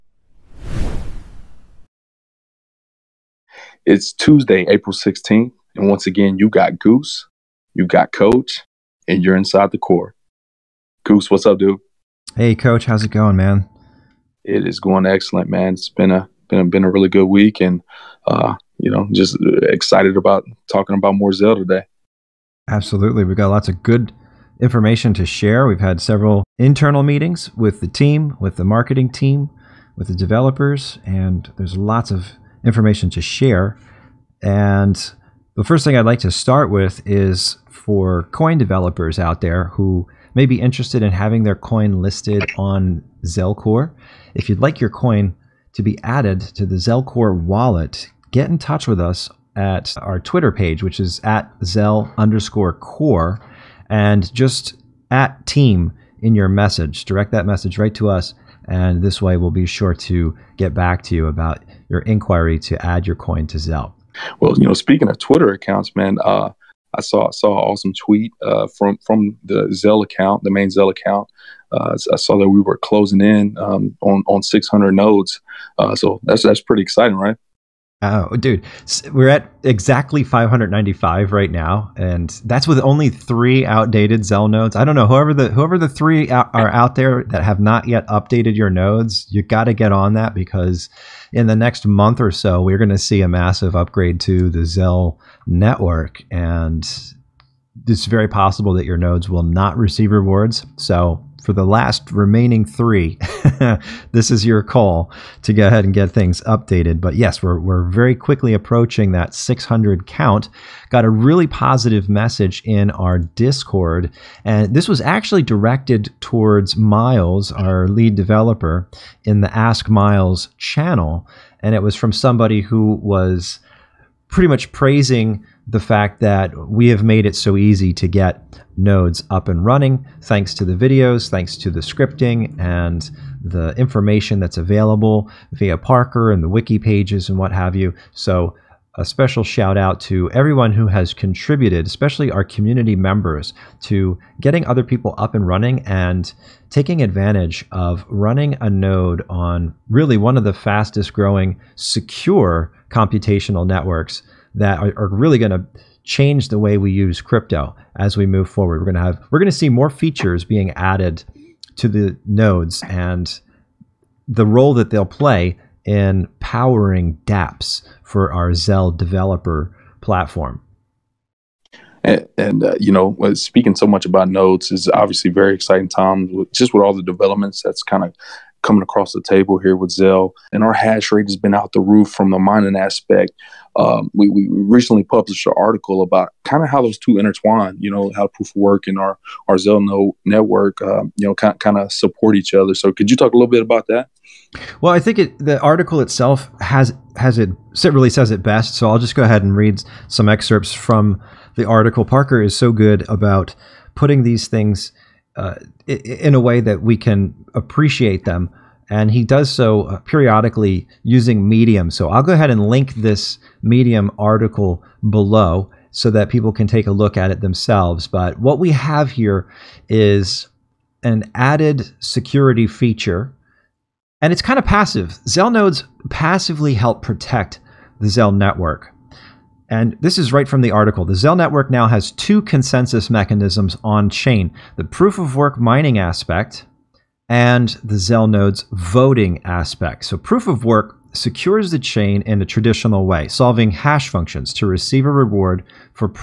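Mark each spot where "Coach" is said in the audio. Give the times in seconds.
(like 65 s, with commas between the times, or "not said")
8 s, 12 s.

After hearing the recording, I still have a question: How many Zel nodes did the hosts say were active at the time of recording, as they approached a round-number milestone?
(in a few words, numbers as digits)
595.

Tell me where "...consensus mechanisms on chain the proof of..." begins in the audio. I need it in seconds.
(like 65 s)
232 s.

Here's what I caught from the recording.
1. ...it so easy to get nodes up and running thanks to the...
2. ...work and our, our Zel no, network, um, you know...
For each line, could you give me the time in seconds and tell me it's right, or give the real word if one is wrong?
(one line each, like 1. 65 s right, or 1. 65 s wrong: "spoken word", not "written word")
1. 127 s right
2. 188 s right.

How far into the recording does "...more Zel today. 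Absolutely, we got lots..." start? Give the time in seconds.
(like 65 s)
21 s.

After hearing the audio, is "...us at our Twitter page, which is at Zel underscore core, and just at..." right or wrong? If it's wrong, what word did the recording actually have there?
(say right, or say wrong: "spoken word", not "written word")
right.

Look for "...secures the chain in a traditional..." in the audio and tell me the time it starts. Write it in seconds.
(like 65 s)
241 s.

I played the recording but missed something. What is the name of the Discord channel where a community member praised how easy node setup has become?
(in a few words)
Ask Miles.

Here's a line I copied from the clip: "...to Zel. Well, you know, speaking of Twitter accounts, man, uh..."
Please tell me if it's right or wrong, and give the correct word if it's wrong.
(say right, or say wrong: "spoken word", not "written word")
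right.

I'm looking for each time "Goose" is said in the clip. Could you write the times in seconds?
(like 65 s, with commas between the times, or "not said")
6 s, 11 s.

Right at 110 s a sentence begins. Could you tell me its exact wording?
Got a really positive message in our Discord.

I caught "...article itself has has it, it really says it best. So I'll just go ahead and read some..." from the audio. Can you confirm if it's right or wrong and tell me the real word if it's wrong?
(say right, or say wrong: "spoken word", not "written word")
right.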